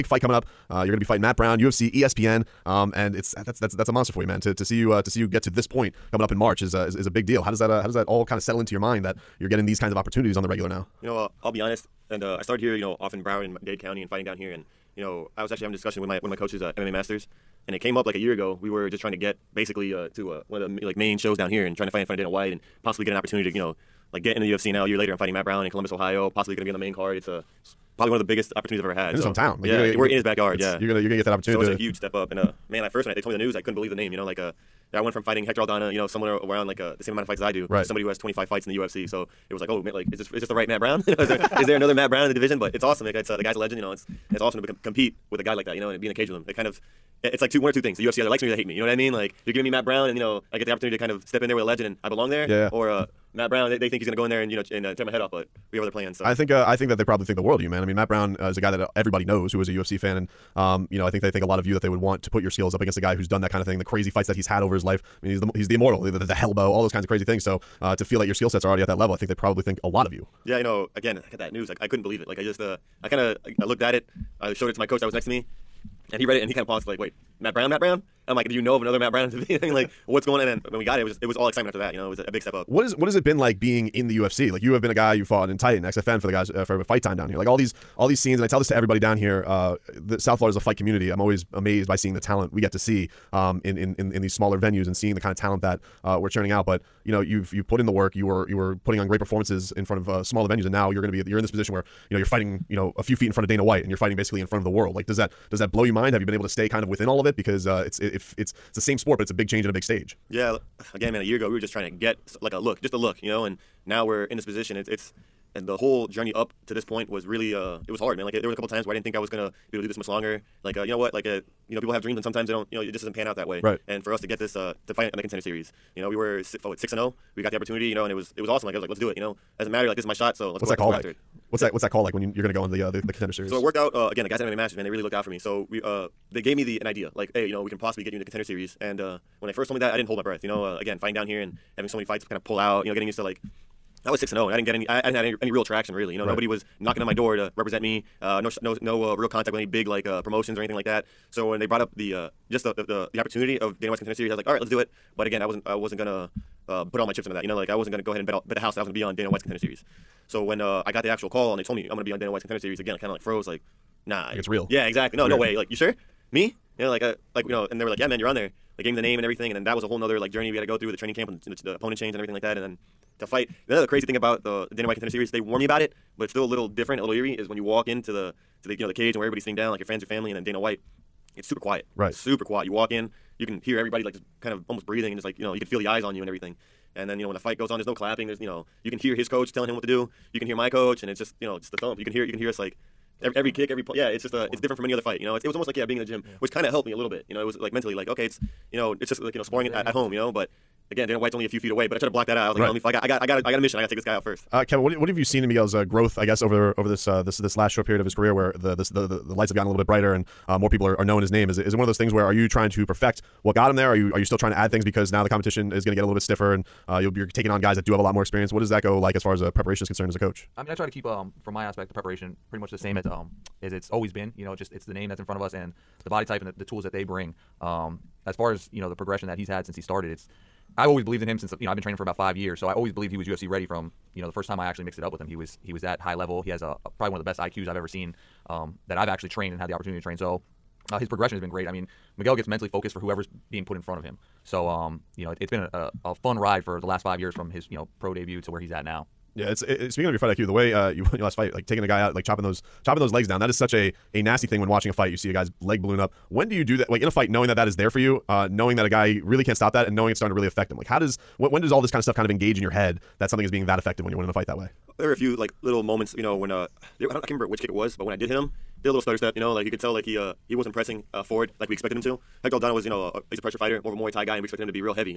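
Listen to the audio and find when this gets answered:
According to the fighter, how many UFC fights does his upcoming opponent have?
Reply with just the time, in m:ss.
0:38.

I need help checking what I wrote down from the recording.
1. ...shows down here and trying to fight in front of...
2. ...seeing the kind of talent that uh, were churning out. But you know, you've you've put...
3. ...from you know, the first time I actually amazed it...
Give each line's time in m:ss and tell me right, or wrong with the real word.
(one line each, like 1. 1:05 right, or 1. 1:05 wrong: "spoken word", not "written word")
1. 0:21 right
2. 1:34 right
3. 3:53 wrong: "mixed", not "amazed".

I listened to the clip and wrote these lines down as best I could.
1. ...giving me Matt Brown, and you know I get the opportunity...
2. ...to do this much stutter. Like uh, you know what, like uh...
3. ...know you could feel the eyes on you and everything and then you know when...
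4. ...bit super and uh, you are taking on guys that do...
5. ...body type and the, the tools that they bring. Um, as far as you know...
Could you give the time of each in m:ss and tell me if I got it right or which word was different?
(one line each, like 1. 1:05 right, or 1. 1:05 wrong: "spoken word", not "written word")
1. 0:49 right
2. 1:59 wrong: "longer", not "stutter"
3. 3:05 right
4. 3:36 wrong: "stiffer", not "super"
5. 3:46 right.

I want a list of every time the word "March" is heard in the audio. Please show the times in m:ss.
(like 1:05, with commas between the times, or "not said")
0:06.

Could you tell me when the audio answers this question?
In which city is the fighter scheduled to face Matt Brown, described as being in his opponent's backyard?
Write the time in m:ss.
0:25.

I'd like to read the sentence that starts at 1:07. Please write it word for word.
So uh, to feel that your skill sets are already at that level, I think they probably think a lot of you.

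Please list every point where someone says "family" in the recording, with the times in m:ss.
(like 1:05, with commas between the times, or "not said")
3:00.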